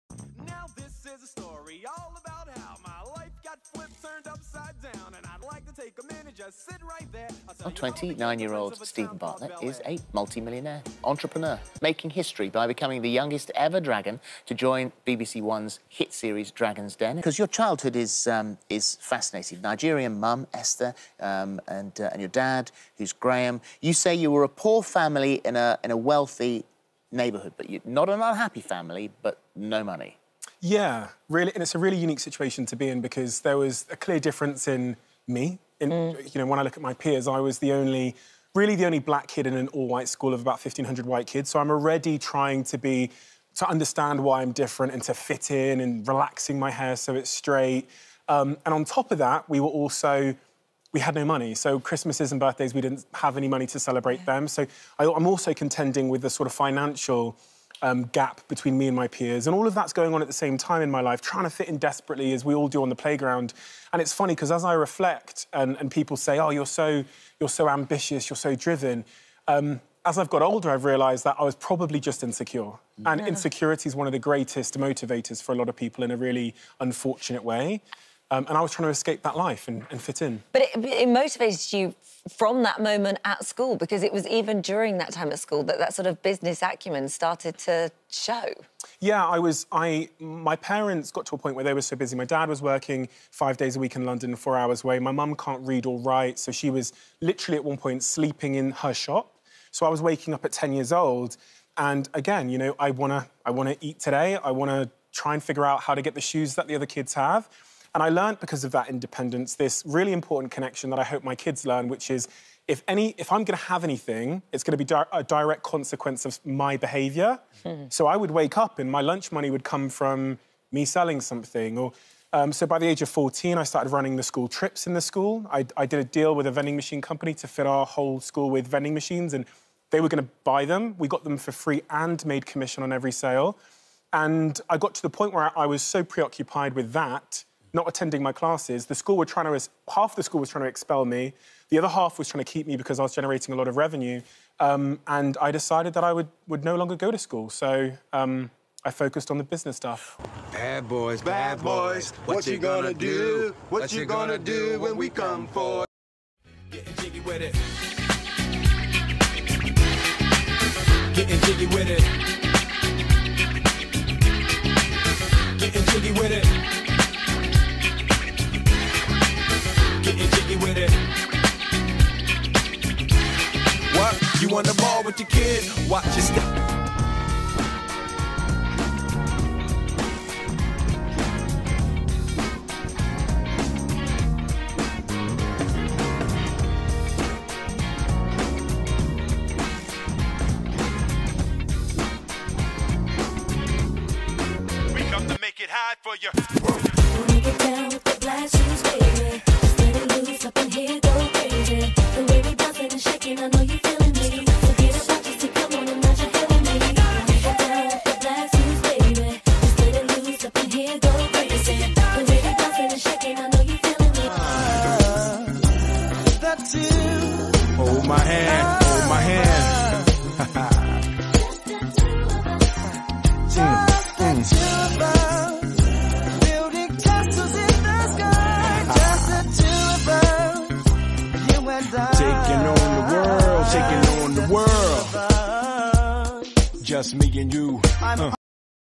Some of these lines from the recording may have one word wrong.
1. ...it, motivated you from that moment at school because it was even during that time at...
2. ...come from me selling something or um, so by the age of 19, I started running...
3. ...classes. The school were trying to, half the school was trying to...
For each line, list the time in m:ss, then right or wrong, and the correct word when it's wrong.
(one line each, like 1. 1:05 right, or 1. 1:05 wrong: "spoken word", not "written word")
1. 1:20 right
2. 1:59 wrong: "14", not "19"
3. 2:18 right.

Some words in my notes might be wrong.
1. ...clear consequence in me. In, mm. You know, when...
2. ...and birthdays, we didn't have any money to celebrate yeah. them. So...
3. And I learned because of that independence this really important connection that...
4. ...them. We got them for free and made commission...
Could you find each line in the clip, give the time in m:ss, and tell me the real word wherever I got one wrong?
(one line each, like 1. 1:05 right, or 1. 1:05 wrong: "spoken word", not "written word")
1. 0:33 wrong: "difference", not "consequence"
2. 0:52 right
3. 1:47 right
4. 2:10 right.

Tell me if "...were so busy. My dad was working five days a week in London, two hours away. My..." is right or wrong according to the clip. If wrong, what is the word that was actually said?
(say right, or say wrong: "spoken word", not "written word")
wrong: "four", not "two".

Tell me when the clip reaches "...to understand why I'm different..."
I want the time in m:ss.
0:43.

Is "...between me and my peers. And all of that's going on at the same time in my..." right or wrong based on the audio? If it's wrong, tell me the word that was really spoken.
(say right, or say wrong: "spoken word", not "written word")
right.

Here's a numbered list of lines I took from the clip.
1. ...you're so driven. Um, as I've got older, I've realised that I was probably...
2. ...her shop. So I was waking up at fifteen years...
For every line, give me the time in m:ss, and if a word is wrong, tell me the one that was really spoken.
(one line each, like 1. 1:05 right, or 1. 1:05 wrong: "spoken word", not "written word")
1. 1:08 right
2. 1:38 wrong: "ten", not "fifteen".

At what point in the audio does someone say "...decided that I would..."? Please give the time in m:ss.
2:25.